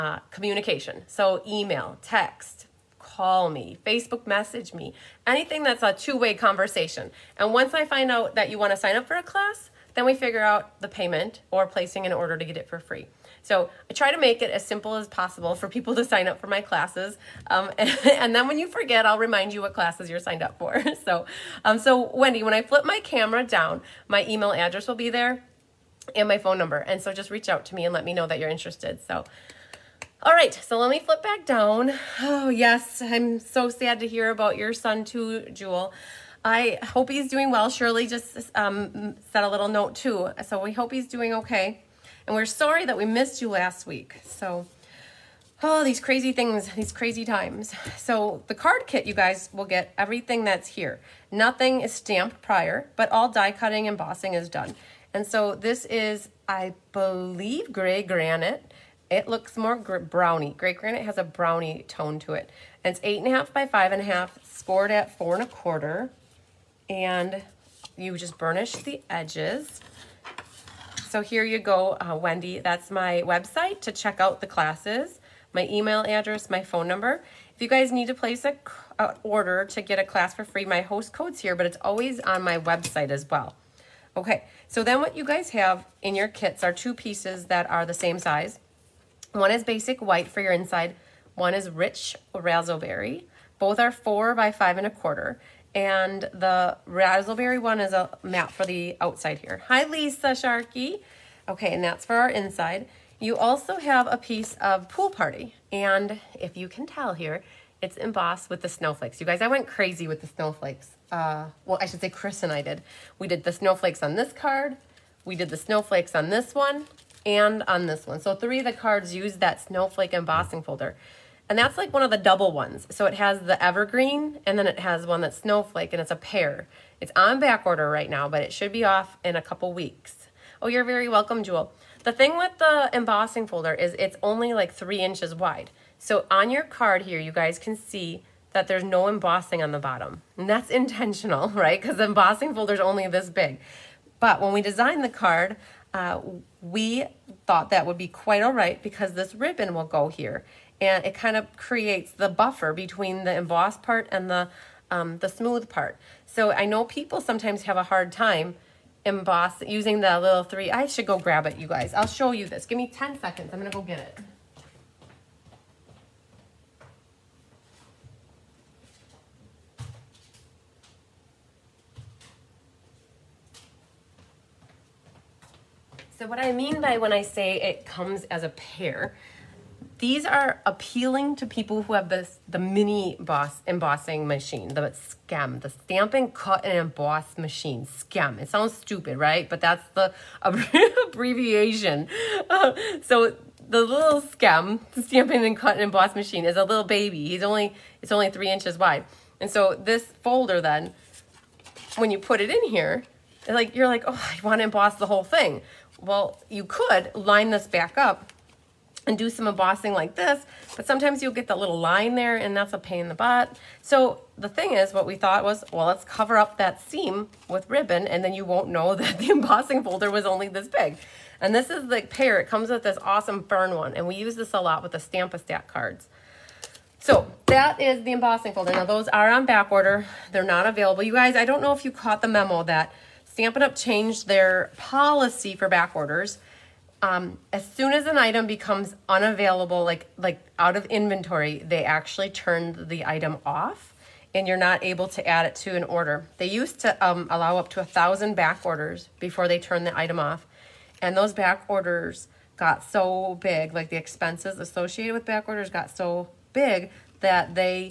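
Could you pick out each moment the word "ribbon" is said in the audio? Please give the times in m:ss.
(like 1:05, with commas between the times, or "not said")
2:29, 3:37.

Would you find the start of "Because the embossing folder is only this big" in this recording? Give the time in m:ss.
2:21.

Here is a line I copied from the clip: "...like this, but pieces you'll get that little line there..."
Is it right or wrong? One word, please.
wrong.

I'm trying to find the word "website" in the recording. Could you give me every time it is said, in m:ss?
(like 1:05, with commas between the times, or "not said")
1:13, 1:22.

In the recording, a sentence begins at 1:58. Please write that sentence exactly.
So three of the cards used that snowflake embossing folder.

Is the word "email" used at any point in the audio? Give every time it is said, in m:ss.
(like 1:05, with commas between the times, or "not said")
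0:01, 0:24, 1:15.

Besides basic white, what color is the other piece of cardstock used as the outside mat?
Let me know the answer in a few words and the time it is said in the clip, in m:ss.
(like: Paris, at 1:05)
Rich razzleberry, at 1:31.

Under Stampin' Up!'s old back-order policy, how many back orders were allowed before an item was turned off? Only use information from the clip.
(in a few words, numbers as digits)
1000.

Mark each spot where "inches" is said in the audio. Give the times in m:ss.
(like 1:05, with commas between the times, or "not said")
2:15, 3:18.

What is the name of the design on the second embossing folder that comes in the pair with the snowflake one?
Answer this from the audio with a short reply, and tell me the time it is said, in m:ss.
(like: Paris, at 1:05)
Fern, at 3:43.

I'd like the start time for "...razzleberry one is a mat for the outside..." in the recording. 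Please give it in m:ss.
1:36.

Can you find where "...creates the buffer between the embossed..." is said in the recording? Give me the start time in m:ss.
2:31.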